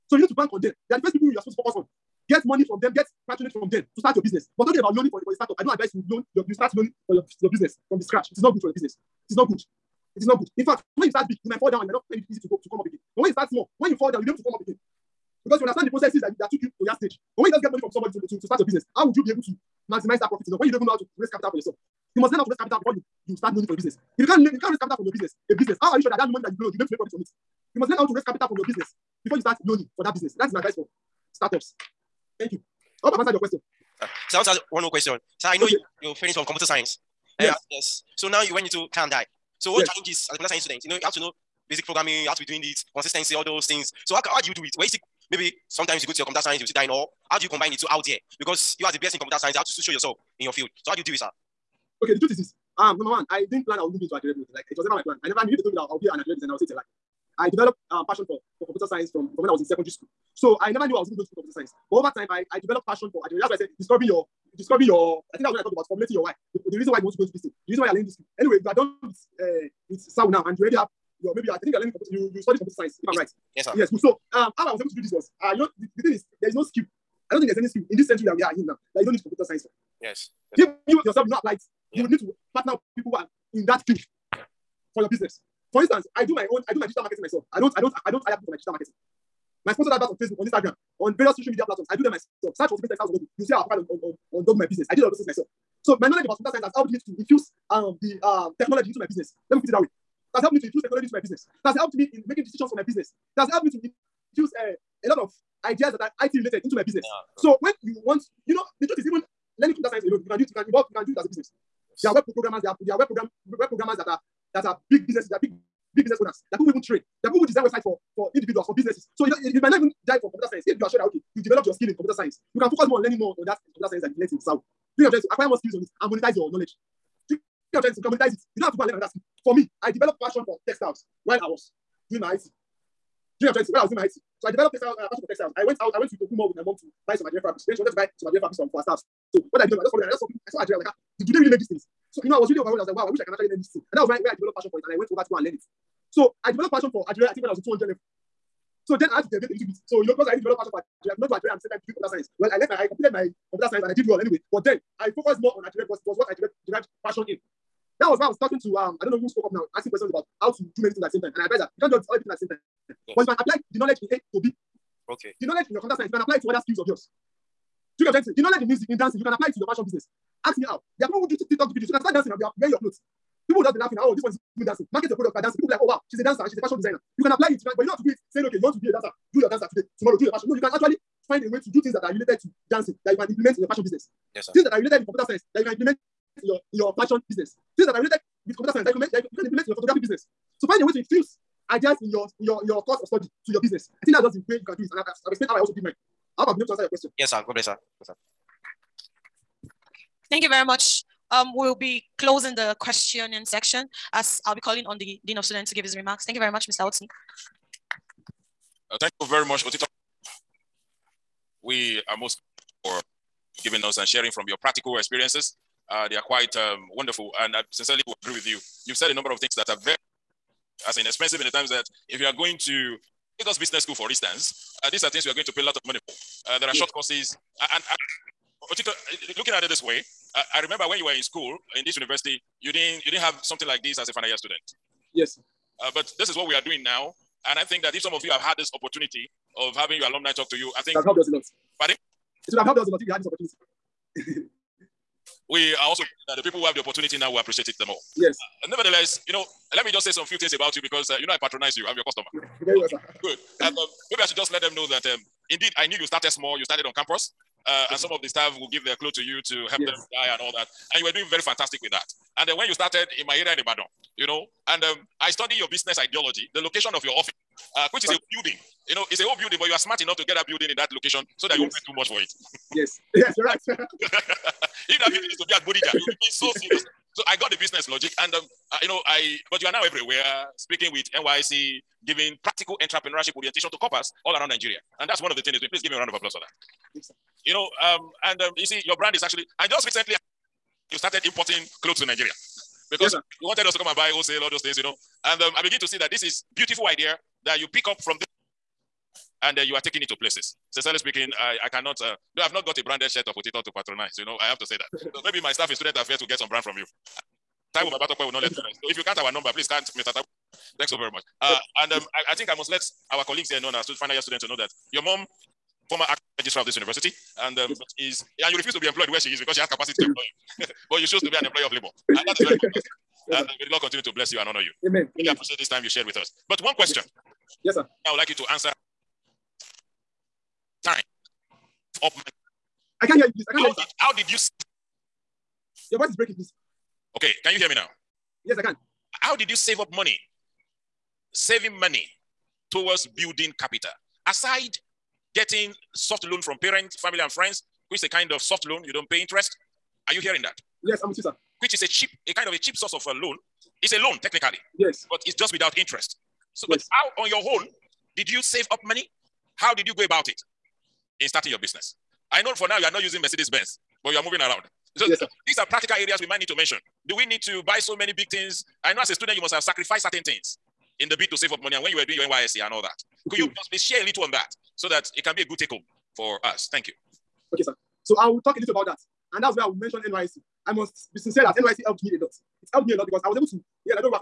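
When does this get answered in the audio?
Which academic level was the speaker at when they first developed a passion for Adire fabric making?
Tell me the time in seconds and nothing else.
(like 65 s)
147 s.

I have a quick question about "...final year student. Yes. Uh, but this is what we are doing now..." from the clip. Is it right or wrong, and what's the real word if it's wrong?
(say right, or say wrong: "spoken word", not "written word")
right.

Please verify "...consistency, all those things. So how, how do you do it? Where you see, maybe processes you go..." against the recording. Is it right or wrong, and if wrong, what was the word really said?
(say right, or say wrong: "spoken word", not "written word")
wrong: "sometimes", not "processes".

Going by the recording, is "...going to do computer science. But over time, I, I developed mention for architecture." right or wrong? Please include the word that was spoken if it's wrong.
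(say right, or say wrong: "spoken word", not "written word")
wrong: "passion", not "mention".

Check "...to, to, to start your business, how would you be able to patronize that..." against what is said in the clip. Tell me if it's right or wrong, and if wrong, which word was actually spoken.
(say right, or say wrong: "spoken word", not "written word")
wrong: "maximize", not "patronize".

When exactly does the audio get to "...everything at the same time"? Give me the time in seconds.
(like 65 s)
161 s.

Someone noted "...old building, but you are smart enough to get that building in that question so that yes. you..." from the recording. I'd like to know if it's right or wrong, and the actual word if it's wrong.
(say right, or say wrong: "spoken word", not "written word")
wrong: "location", not "question".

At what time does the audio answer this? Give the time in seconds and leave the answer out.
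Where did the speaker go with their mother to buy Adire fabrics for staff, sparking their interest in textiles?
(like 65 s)
136 s.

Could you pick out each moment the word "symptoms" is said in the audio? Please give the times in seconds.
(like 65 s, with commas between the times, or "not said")
not said.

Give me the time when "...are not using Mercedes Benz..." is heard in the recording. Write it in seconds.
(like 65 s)
362 s.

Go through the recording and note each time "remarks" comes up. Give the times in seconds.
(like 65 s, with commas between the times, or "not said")
205 s.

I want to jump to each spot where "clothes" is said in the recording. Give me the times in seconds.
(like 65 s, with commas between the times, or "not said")
172 s, 291 s.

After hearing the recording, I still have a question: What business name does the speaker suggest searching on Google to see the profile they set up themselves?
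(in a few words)
Tipping Textiles.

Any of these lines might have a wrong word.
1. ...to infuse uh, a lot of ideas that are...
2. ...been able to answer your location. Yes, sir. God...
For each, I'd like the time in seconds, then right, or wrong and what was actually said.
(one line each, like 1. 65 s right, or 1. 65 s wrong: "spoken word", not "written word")
1. 103 s right
2. 196 s wrong: "question", not "location".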